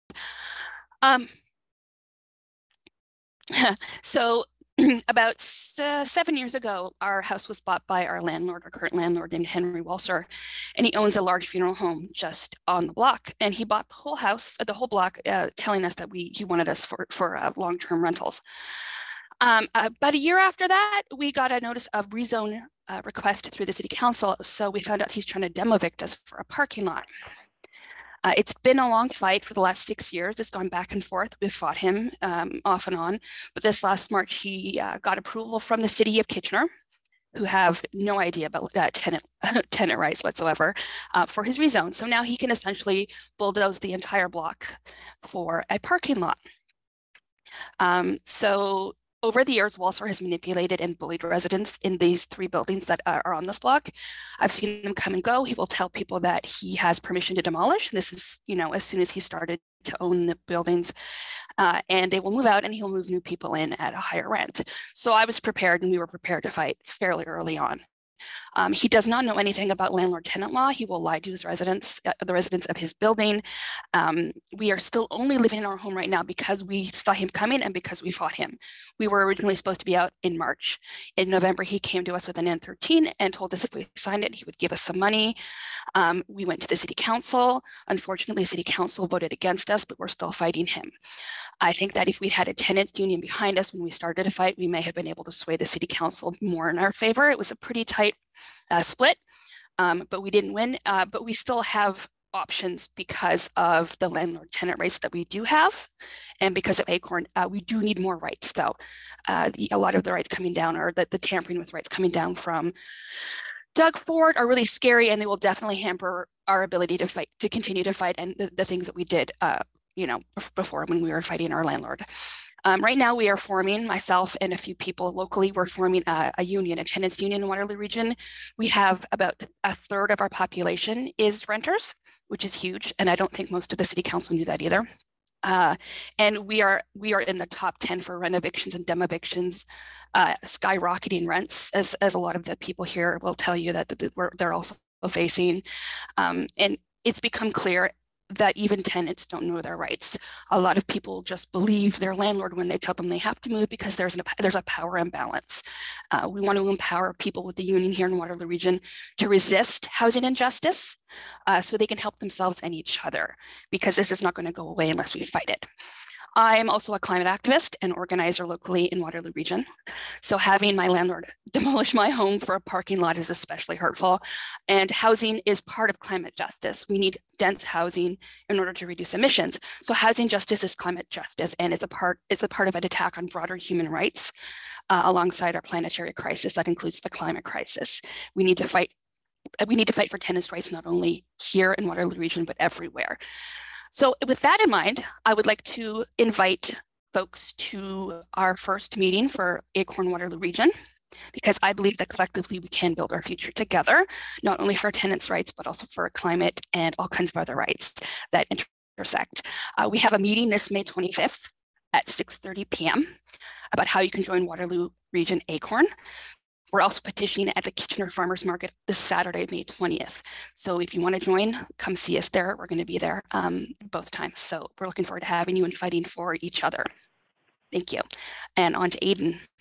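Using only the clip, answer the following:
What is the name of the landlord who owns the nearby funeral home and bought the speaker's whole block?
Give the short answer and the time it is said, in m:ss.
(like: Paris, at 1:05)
Henry Walser, at 0:09.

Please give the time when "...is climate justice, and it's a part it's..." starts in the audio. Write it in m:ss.
3:00.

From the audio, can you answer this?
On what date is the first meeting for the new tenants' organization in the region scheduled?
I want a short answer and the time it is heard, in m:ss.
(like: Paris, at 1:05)
May 25, at 3:30.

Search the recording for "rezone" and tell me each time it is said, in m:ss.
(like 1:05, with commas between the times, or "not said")
0:22, 0:41.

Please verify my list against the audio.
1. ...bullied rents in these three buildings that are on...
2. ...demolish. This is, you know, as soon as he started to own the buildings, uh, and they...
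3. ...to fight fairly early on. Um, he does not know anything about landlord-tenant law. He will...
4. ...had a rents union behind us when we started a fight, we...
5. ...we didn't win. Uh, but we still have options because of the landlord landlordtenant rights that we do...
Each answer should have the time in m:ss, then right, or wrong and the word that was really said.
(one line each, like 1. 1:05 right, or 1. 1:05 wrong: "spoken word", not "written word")
1. 0:50 wrong: "residents", not "rents"
2. 0:57 right
3. 1:06 right
4. 1:32 wrong: "tenants", not "rents"
5. 1:40 wrong: "tenant", not "landlordtenant".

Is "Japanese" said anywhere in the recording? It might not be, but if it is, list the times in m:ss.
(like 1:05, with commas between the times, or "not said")
not said.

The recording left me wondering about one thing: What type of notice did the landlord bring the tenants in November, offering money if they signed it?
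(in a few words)
N13.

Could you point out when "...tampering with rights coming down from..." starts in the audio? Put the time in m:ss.
1:51.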